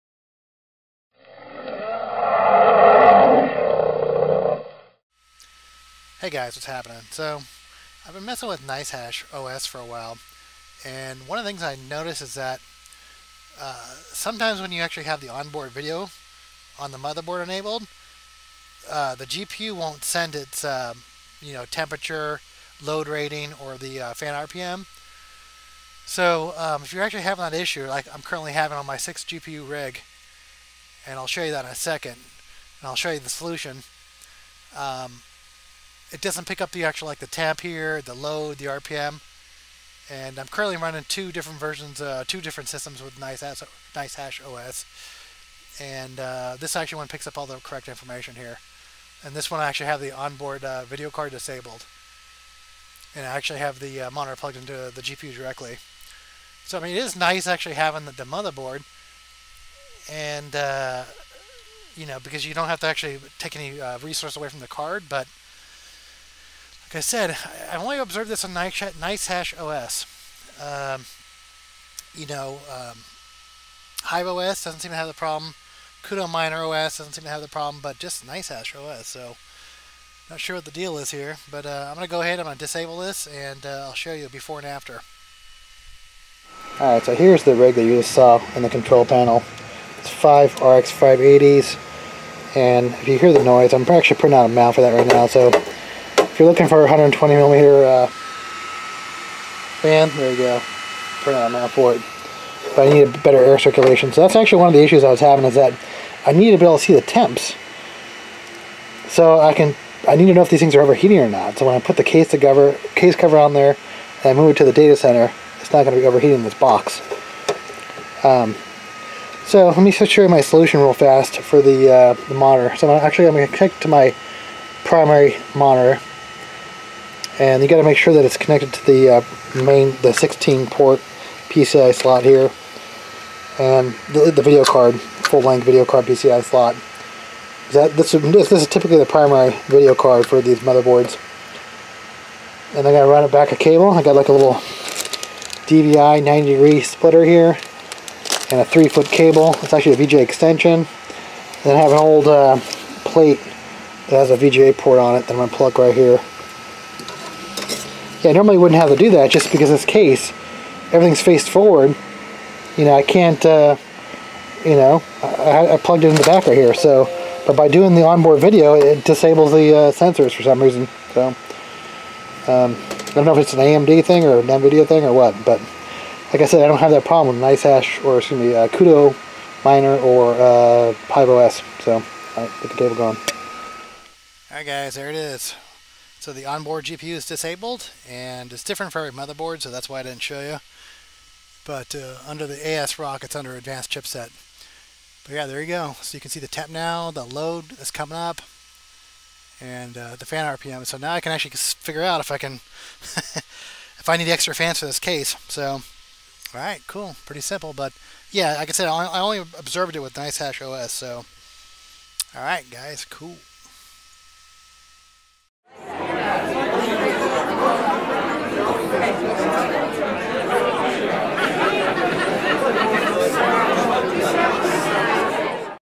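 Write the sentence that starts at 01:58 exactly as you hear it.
Um, so let me show you my solution real fast for the, uh, the monitor.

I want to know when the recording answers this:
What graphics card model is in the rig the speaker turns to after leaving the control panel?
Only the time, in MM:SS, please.
01:30.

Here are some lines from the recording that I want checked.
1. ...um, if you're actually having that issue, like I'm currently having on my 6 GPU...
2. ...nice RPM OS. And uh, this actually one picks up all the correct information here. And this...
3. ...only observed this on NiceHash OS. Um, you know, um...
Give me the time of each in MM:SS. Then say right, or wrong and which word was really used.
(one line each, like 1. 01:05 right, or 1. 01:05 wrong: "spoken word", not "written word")
1. 00:26 right
2. 00:43 wrong: "Hash", not "RPM"
3. 01:07 right.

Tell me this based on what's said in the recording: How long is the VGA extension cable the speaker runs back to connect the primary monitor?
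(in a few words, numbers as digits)
3 feet.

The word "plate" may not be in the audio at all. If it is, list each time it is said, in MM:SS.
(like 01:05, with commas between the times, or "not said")
02:33.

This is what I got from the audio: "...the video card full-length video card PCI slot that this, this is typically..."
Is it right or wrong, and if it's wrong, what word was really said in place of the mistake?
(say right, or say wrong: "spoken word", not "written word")
right.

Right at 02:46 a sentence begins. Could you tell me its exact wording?
So, but by doing the onboard video, it disables the uh, sensors for some reason.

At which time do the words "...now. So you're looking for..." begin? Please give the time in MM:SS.
01:35.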